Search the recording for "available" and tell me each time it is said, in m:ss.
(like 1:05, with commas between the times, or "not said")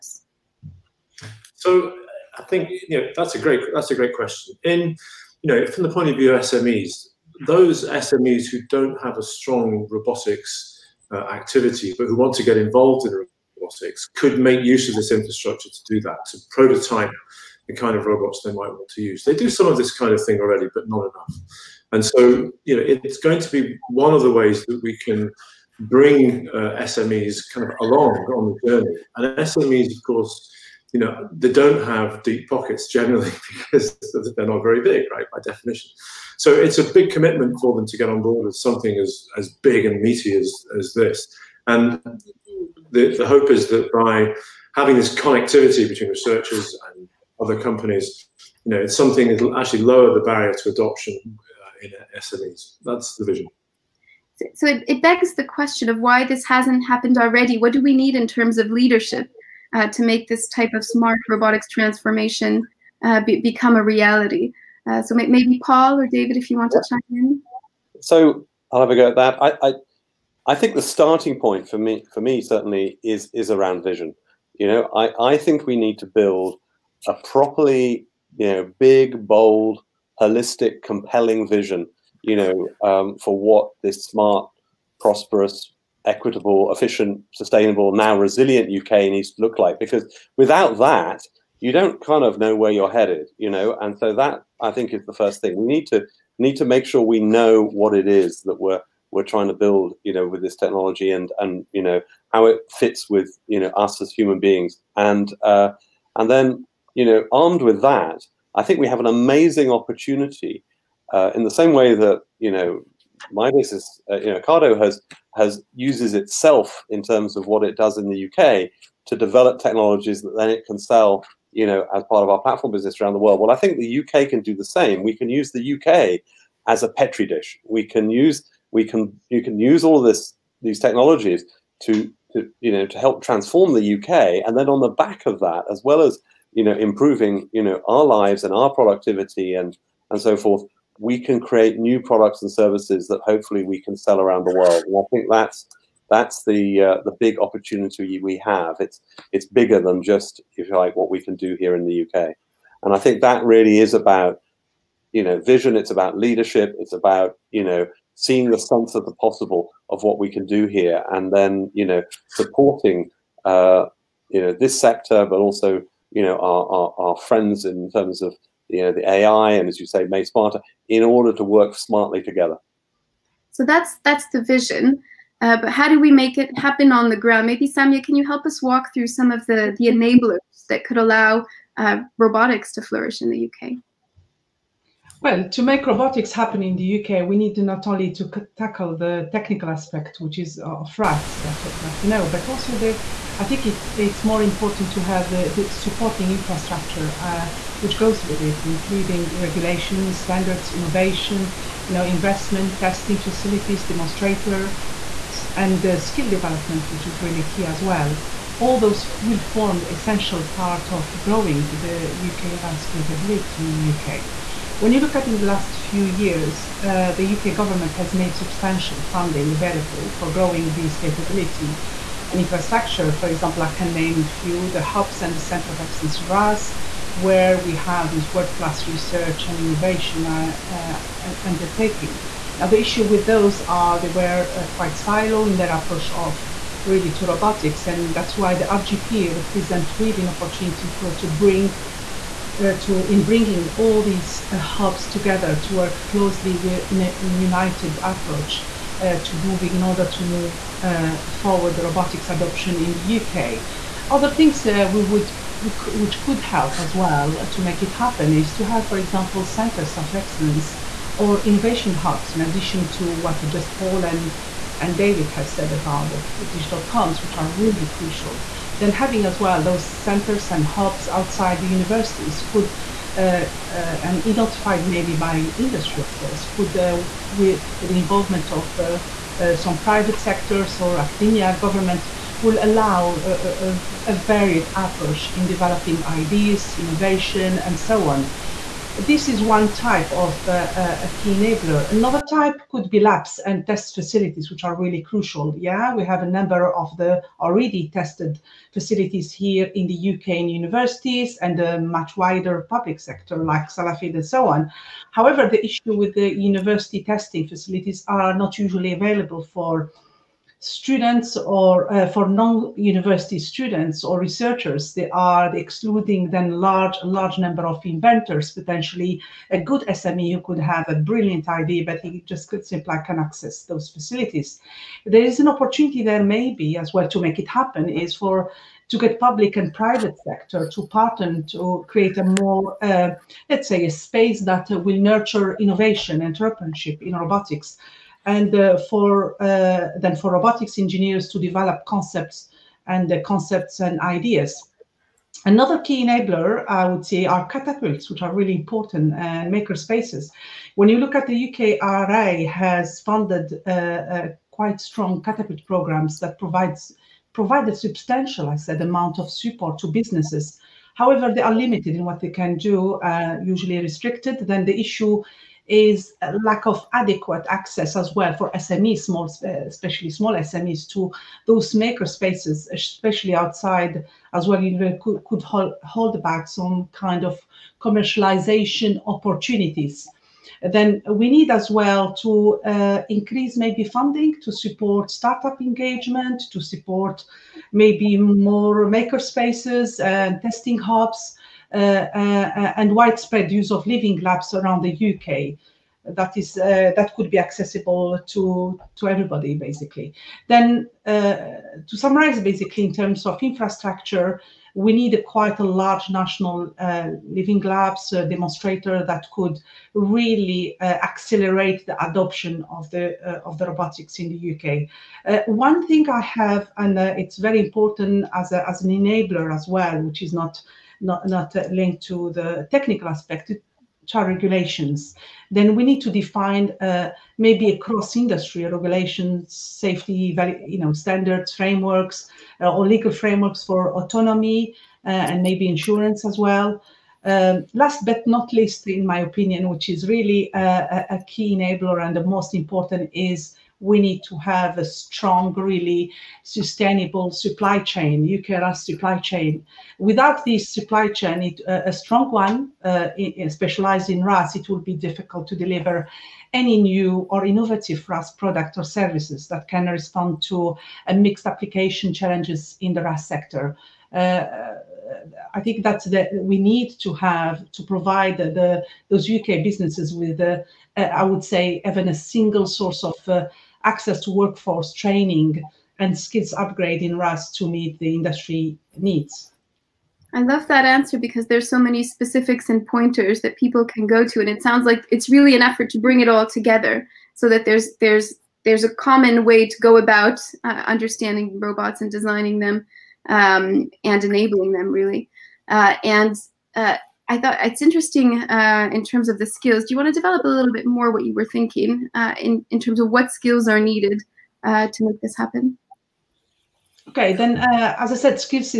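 3:39, 5:08.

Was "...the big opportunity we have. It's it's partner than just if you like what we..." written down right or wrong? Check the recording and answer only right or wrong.
wrong.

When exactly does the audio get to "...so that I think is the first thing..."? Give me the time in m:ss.
1:33.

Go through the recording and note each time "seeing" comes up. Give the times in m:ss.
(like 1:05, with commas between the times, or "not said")
2:38.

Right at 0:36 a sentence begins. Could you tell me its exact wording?
So it's a big commitment for them to get on board with something as, as big and meaty as, as this.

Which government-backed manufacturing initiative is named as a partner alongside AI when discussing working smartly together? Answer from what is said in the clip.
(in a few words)
Made Smarter.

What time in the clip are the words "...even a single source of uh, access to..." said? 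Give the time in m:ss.
7:51.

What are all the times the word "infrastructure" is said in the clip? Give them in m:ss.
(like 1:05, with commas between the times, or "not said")
0:15, 3:16, 3:42, 6:43.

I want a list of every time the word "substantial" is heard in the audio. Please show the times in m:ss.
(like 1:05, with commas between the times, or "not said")
3:38, 5:57.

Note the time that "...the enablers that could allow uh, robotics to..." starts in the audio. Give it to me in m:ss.
2:59.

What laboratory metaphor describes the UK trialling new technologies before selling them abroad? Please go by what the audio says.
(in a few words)
petri dish.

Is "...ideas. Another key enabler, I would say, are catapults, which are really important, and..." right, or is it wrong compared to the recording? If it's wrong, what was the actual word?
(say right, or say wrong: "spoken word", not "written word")
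right.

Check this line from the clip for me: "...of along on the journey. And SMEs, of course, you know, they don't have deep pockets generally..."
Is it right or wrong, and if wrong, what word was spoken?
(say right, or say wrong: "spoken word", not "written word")
right.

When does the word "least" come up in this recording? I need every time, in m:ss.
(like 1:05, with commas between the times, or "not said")
7:18.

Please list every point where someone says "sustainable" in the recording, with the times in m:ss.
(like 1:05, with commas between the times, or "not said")
1:27, 7:26.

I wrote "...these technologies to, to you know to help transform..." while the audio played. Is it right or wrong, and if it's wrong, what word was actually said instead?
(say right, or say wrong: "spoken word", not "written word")
right.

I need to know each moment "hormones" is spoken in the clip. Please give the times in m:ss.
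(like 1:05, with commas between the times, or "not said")
not said.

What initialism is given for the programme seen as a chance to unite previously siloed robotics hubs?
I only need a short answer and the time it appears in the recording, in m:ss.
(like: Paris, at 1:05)
RGP, at 3:58.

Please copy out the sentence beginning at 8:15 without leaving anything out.
Uh, and uh, I thought it's interesting uh, in terms of the skills.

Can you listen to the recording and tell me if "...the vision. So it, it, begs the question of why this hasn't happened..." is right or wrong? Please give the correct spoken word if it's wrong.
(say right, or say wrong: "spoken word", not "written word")
right.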